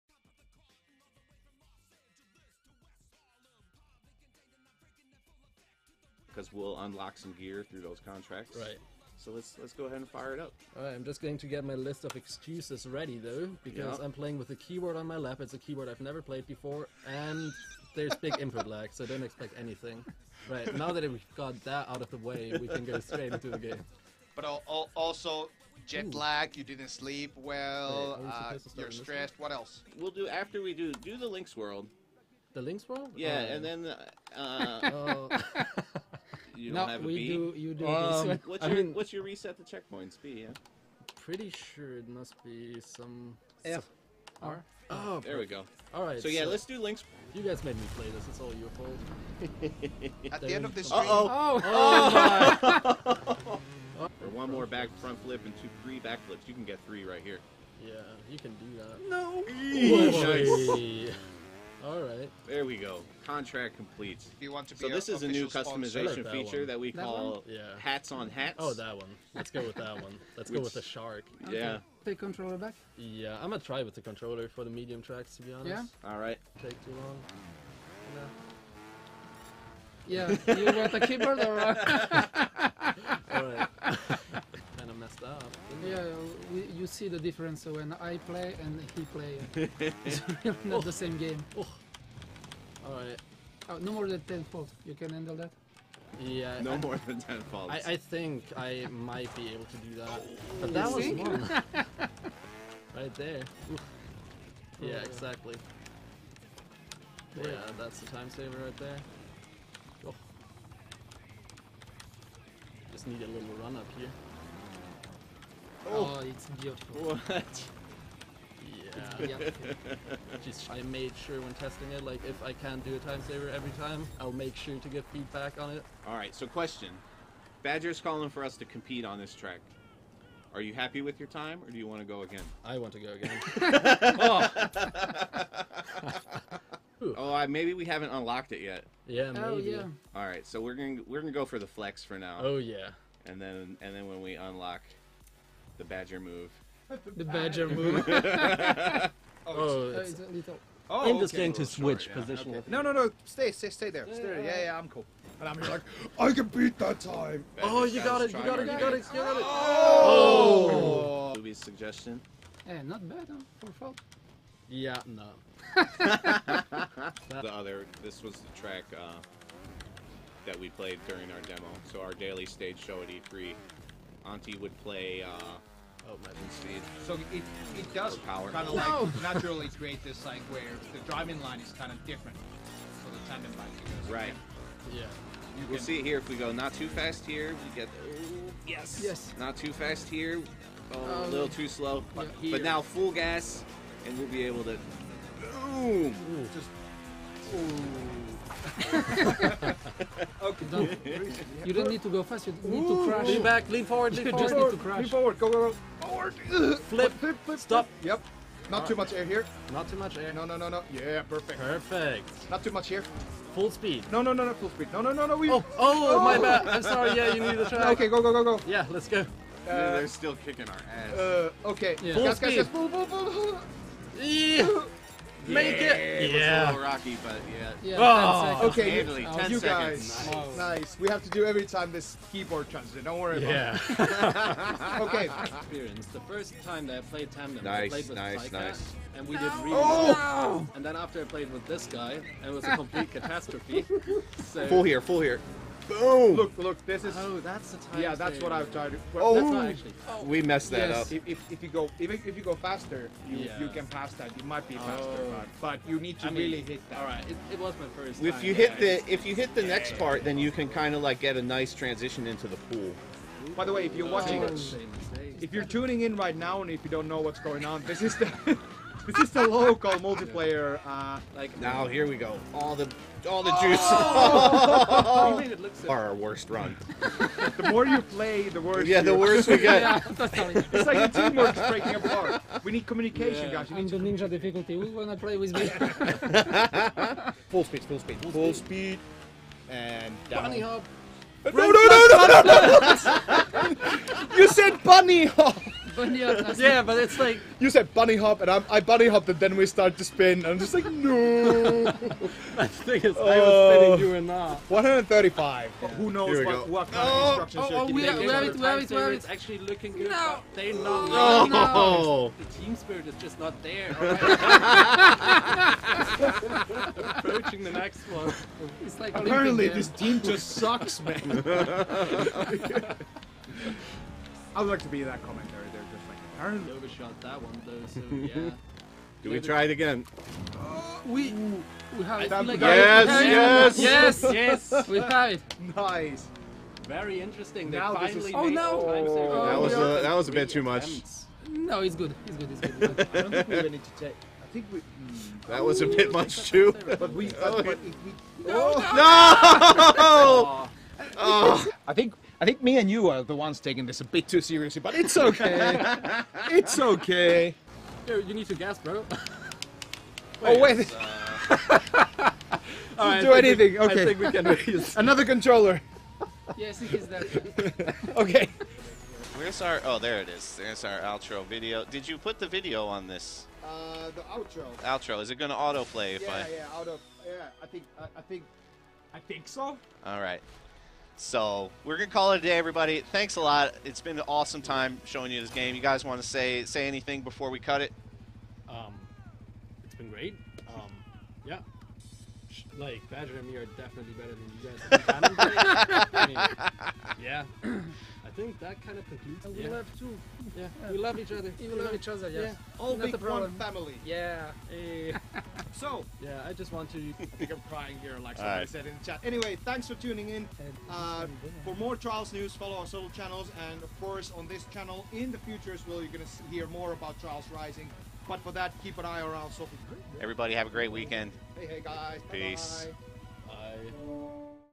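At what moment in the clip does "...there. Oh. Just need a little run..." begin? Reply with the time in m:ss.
1:48.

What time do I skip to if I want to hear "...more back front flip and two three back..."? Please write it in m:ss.
0:54.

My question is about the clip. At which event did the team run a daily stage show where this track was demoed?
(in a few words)
E3.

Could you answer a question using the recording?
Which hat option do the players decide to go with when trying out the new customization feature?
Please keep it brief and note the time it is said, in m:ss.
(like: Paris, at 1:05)
the shark, at 1:10.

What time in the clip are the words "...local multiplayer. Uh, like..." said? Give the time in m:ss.
4:29.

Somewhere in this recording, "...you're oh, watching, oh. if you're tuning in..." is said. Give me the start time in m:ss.
4:23.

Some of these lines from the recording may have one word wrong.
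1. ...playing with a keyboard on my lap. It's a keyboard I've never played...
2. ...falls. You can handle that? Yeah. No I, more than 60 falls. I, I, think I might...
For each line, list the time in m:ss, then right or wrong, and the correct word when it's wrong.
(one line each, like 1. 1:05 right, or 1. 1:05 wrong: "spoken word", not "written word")
1. 0:14 right
2. 1:34 wrong: "10", not "60".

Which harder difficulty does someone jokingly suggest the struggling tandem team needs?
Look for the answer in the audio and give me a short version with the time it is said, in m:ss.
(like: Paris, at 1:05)
ninja, at 4:43.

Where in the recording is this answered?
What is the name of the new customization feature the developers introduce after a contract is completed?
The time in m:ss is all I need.
1:07.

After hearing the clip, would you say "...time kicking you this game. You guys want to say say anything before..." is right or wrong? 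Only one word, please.
wrong.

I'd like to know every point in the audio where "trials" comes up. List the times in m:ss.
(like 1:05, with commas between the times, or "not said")
6:51, 6:57.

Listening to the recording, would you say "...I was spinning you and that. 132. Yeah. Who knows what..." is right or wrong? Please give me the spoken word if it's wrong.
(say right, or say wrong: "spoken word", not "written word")
wrong: "135", not "132".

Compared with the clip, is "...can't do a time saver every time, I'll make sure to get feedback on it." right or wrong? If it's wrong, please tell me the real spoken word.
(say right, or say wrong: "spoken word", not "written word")
right.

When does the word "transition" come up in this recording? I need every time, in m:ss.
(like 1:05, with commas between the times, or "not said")
4:21.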